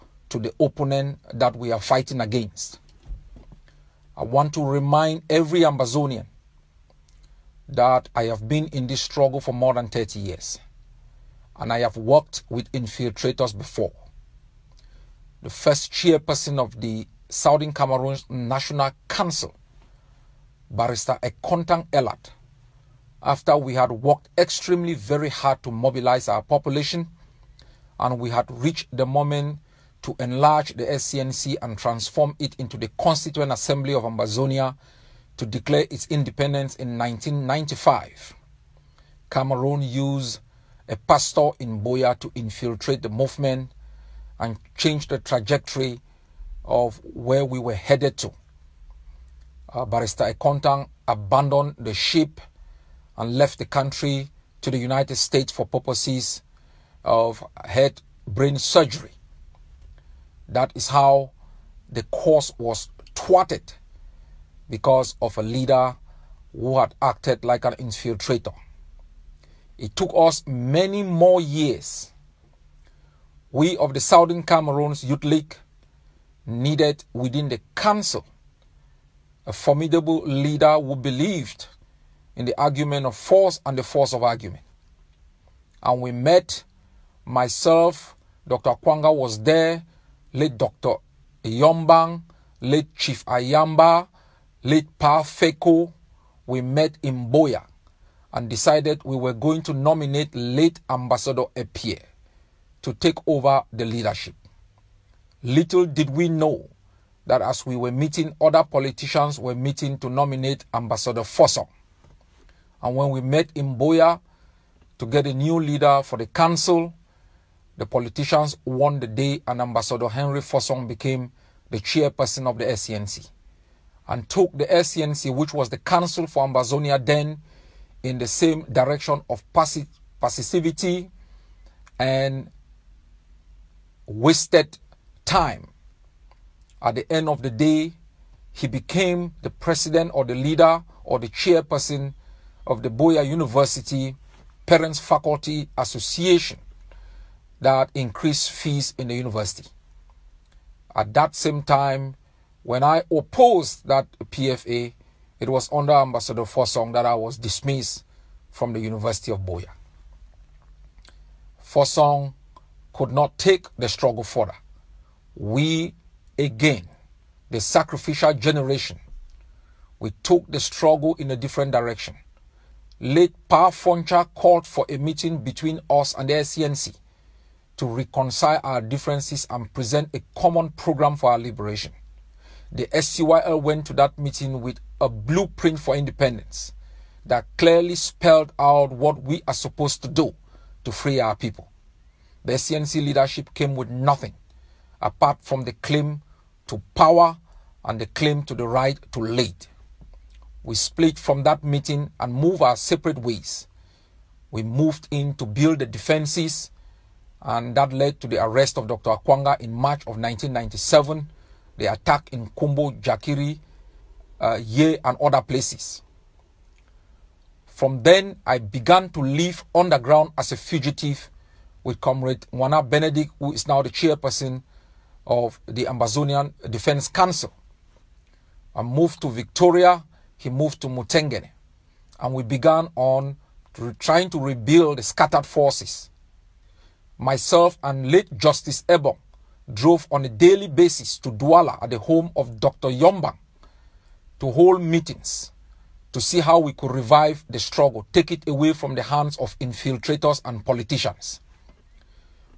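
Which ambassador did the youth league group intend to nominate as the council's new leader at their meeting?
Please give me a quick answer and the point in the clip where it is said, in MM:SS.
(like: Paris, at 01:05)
Ambassador Epie, at 01:40.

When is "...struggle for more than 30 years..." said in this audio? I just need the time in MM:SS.
00:09.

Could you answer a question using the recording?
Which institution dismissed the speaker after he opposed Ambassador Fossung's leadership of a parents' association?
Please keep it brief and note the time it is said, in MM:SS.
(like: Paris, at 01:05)
University of Buea, at 02:38.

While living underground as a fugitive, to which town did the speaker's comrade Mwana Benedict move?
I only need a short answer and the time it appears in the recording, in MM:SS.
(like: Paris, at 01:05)
Mutengene, at 03:50.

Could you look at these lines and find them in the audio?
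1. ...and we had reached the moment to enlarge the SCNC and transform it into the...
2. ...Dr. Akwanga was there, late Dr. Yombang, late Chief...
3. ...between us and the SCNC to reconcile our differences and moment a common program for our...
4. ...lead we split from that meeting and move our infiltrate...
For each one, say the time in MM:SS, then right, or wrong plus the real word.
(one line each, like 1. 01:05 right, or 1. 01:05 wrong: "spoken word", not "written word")
1. 00:27 right
2. 01:28 right
3. 02:55 wrong: "present", not "moment"
4. 03:19 wrong: "separate", not "infiltrate".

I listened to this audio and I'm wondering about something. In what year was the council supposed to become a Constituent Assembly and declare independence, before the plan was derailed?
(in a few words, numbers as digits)
1995.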